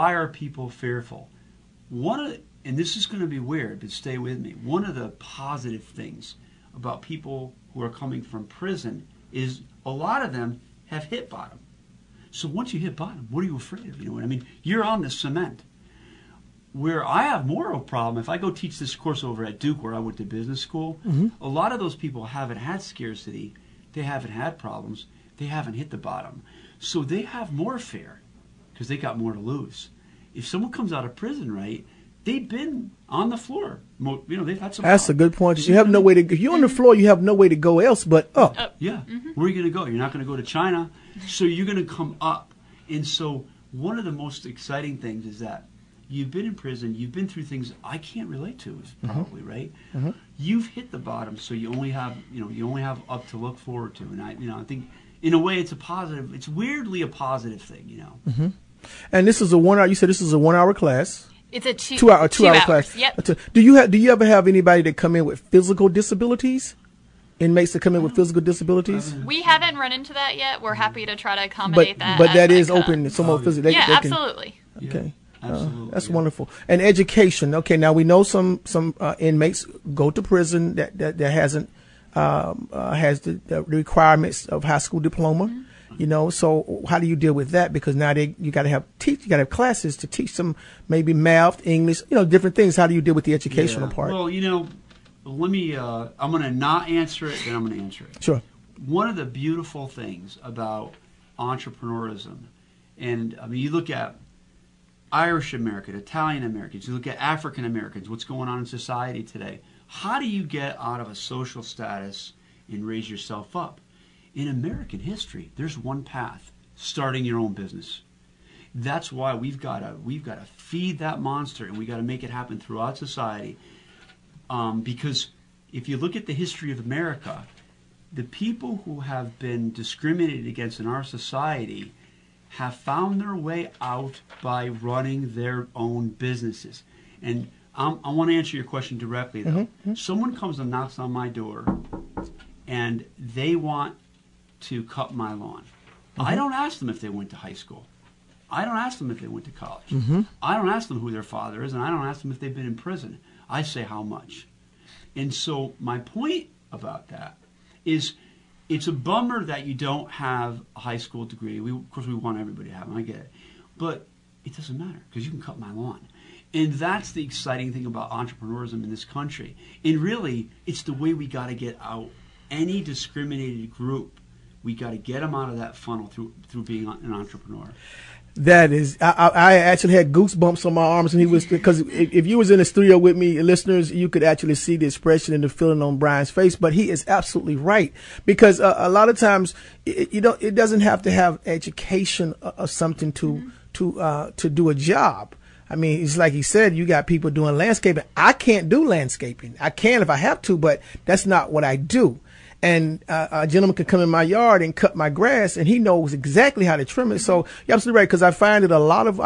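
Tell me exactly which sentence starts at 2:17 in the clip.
And I'm, i want to answer your question directly, though.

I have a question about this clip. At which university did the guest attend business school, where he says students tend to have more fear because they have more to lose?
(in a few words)
Duke.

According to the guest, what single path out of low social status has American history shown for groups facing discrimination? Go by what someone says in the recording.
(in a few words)
starting your own business.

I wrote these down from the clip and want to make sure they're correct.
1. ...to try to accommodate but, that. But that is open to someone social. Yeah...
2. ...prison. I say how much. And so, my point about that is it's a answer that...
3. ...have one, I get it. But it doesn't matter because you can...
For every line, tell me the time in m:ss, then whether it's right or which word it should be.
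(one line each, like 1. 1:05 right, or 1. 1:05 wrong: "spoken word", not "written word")
1. 1:11 wrong: "physical", not "social"
2. 2:32 wrong: "bummer", not "answer"
3. 2:42 right.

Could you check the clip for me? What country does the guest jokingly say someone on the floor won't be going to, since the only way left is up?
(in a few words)
China.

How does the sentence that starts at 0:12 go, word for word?
So once you hit bottom, what are you afraid of?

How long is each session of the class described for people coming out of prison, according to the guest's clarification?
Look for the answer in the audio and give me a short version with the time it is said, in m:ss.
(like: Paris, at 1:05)
2 hours, at 1:02.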